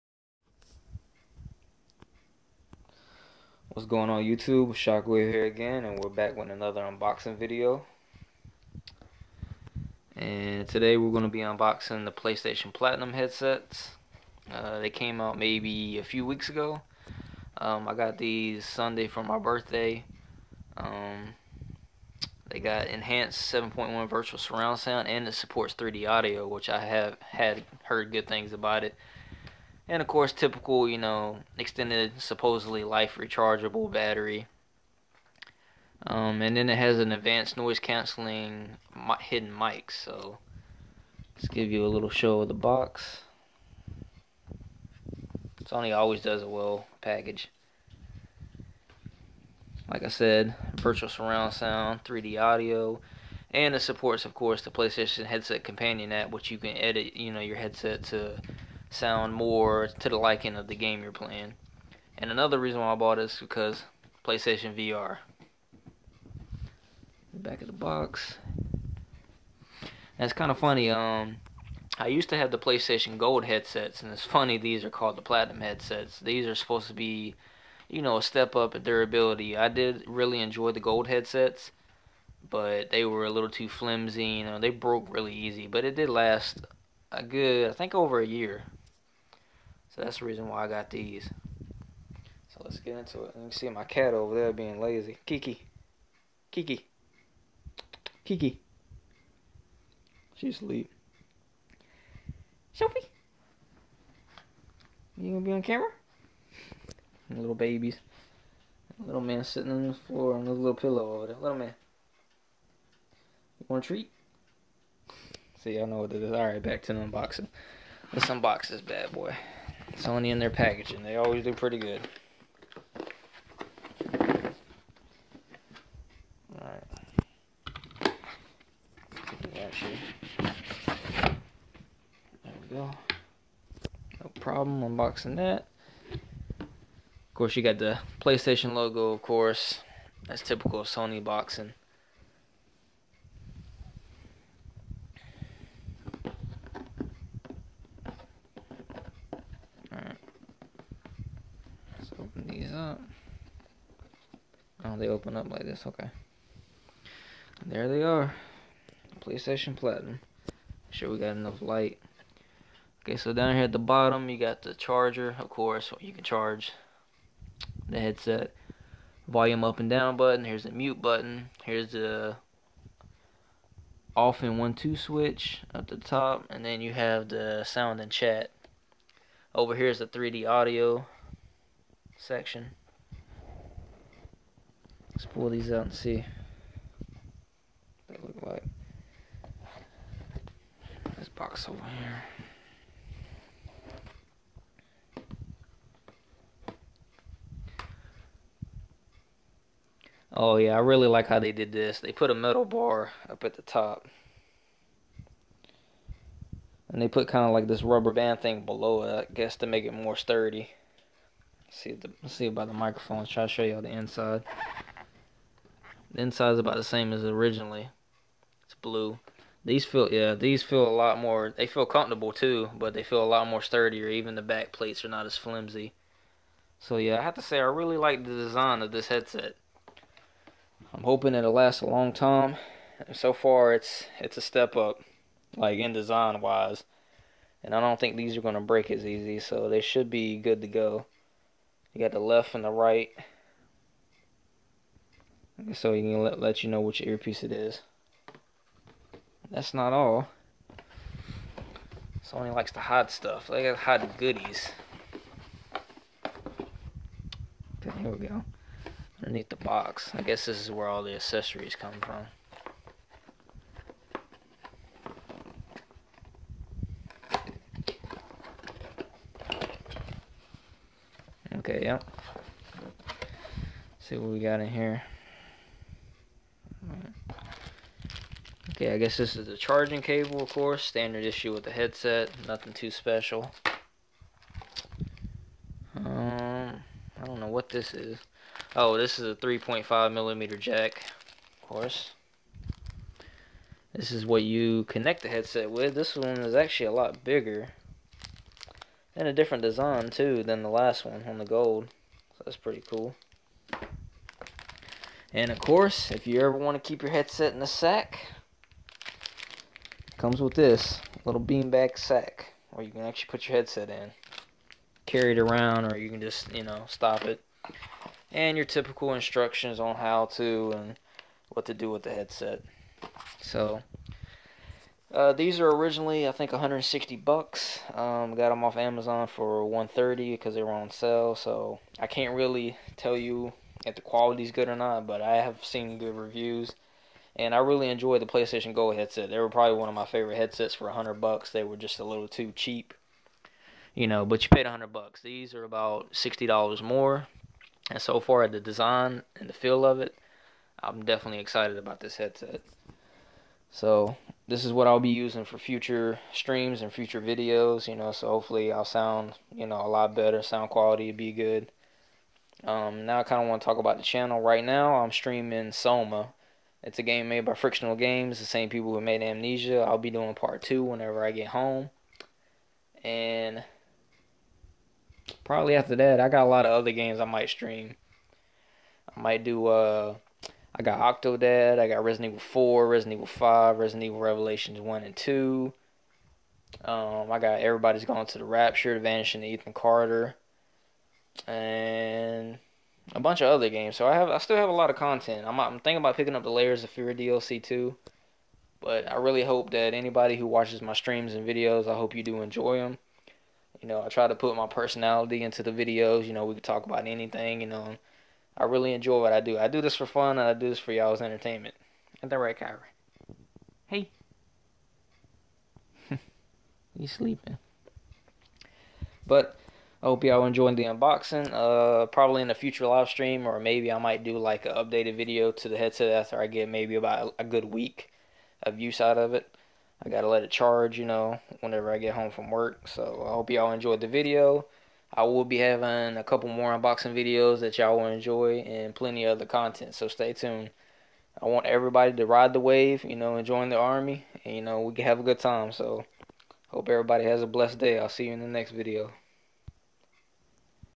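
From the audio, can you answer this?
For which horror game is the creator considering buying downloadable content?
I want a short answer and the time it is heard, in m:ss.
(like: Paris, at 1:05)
Layers of Fear, at 6:36.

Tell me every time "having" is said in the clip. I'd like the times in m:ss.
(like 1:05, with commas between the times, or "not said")
7:15.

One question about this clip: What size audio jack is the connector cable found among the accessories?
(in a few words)
3.5 millimeter.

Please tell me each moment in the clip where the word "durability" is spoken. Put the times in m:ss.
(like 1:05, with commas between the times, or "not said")
1:18.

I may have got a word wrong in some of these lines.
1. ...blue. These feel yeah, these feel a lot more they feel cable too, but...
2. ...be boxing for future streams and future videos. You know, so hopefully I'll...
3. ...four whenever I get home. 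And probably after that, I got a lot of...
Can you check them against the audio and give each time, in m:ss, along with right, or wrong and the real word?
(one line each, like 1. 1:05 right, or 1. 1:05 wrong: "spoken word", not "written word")
1. 3:38 wrong: "comfortable", not "cable"
2. 5:54 wrong: "using", not "boxing"
3. 6:10 wrong: "two", not "four".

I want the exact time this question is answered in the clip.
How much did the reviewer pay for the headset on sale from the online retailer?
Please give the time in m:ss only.
5:29.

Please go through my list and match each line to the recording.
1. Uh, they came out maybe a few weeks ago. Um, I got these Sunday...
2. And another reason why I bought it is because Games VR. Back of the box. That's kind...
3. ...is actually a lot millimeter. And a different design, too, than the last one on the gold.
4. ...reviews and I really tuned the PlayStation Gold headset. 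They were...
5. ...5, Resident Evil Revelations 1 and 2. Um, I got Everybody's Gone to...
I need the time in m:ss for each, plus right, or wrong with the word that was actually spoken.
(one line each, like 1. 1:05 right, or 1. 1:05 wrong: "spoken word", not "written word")
1. 0:14 right
2. 1:02 wrong: "PlayStation", not "Games"
3. 4:56 wrong: "bigger", not "millimeter"
4. 5:36 wrong: "enjoyed", not "tuned"
5. 6:23 right.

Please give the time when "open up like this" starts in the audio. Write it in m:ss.
2:35.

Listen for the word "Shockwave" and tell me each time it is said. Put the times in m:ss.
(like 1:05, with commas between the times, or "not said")
0:04.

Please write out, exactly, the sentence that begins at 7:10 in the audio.
I gotta let it charge, you know, whenever I get home from work.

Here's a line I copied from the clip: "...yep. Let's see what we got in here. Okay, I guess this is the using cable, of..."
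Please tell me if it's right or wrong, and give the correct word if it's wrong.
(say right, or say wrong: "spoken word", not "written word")
wrong: "charging", not "using".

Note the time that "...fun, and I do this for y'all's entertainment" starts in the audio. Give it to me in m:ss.
6:50.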